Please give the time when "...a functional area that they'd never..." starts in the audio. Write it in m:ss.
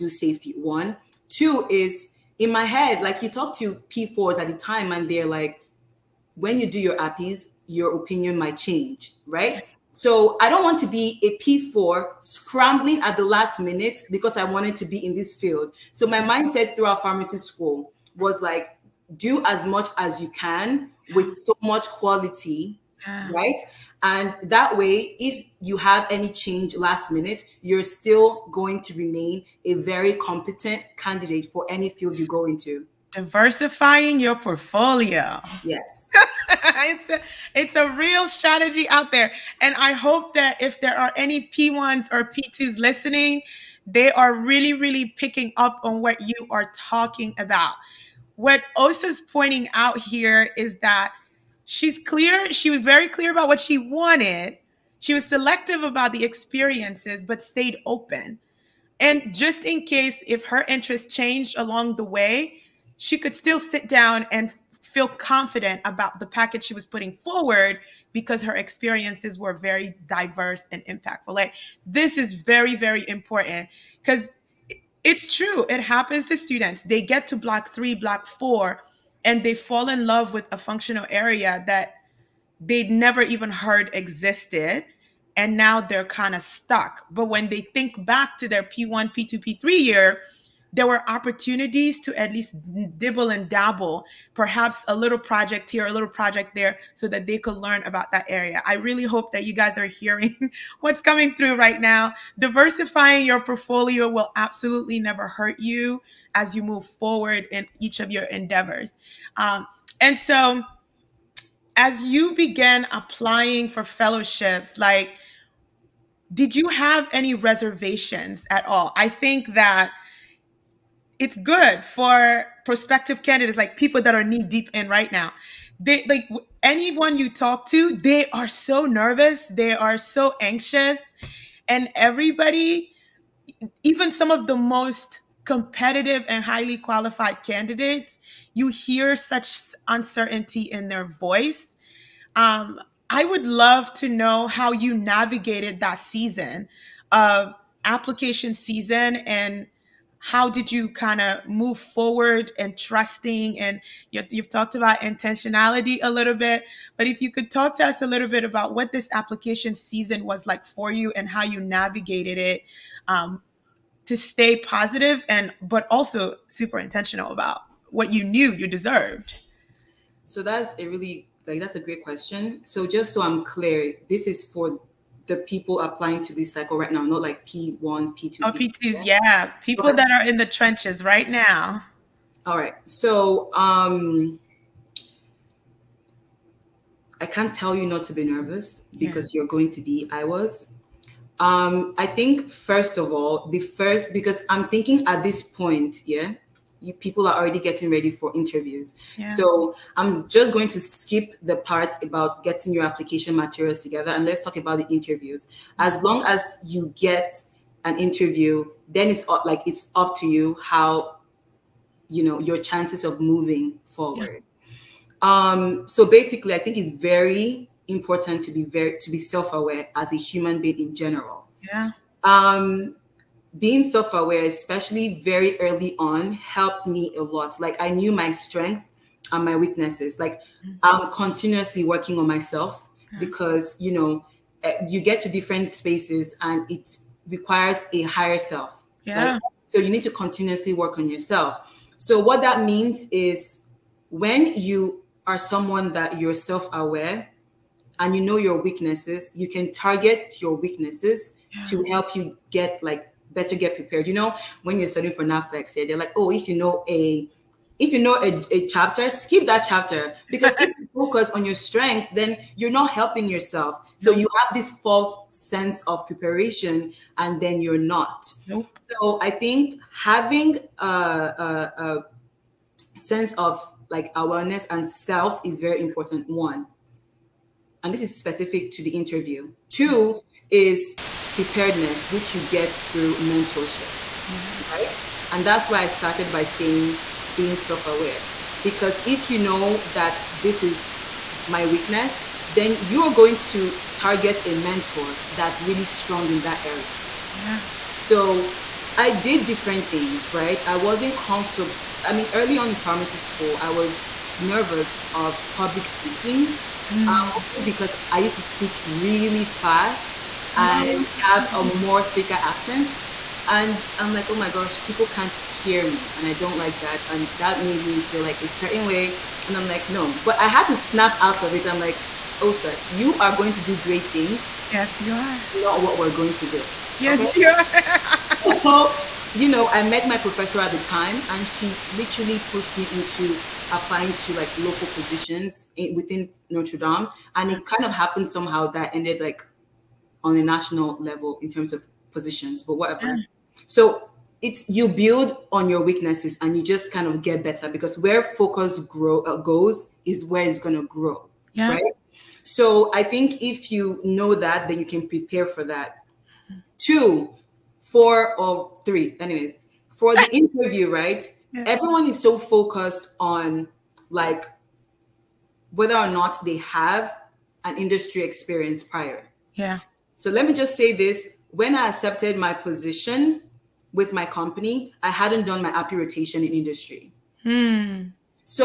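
1:20.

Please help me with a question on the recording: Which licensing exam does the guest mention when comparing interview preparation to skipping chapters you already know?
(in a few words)
NAPLEX.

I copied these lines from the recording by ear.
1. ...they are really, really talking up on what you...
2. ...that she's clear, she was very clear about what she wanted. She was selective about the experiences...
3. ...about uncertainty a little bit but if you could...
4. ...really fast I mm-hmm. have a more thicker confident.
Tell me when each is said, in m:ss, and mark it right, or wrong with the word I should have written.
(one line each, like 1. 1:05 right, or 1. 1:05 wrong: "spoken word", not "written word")
1. 0:43 wrong: "picking", not "talking"
2. 0:50 right
3. 2:34 wrong: "intentionality", not "uncertainty"
4. 5:08 wrong: "accent", not "confident".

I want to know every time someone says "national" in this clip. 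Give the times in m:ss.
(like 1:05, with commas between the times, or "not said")
5:40.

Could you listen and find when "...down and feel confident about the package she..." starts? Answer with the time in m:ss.
1:03.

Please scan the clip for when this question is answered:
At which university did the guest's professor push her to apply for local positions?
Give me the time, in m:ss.
5:36.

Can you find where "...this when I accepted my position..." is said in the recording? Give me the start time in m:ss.
6:10.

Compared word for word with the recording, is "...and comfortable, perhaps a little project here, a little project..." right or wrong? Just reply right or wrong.
wrong.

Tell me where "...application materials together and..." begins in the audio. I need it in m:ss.
3:22.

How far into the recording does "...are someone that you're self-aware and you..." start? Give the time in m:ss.
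4:05.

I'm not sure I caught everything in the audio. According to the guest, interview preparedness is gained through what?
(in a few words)
mentorship.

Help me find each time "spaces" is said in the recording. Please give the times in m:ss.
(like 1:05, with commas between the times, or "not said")
3:55.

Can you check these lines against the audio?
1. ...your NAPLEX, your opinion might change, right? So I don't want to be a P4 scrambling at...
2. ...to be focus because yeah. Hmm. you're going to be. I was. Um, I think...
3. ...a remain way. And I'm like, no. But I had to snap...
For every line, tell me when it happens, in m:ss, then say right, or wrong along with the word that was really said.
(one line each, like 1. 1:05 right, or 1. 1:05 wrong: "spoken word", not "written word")
1. 0:06 wrong: "APPEs", not "NAPLEX"
2. 3:08 wrong: "nervous", not "focus"
3. 5:18 wrong: "certain", not "remain".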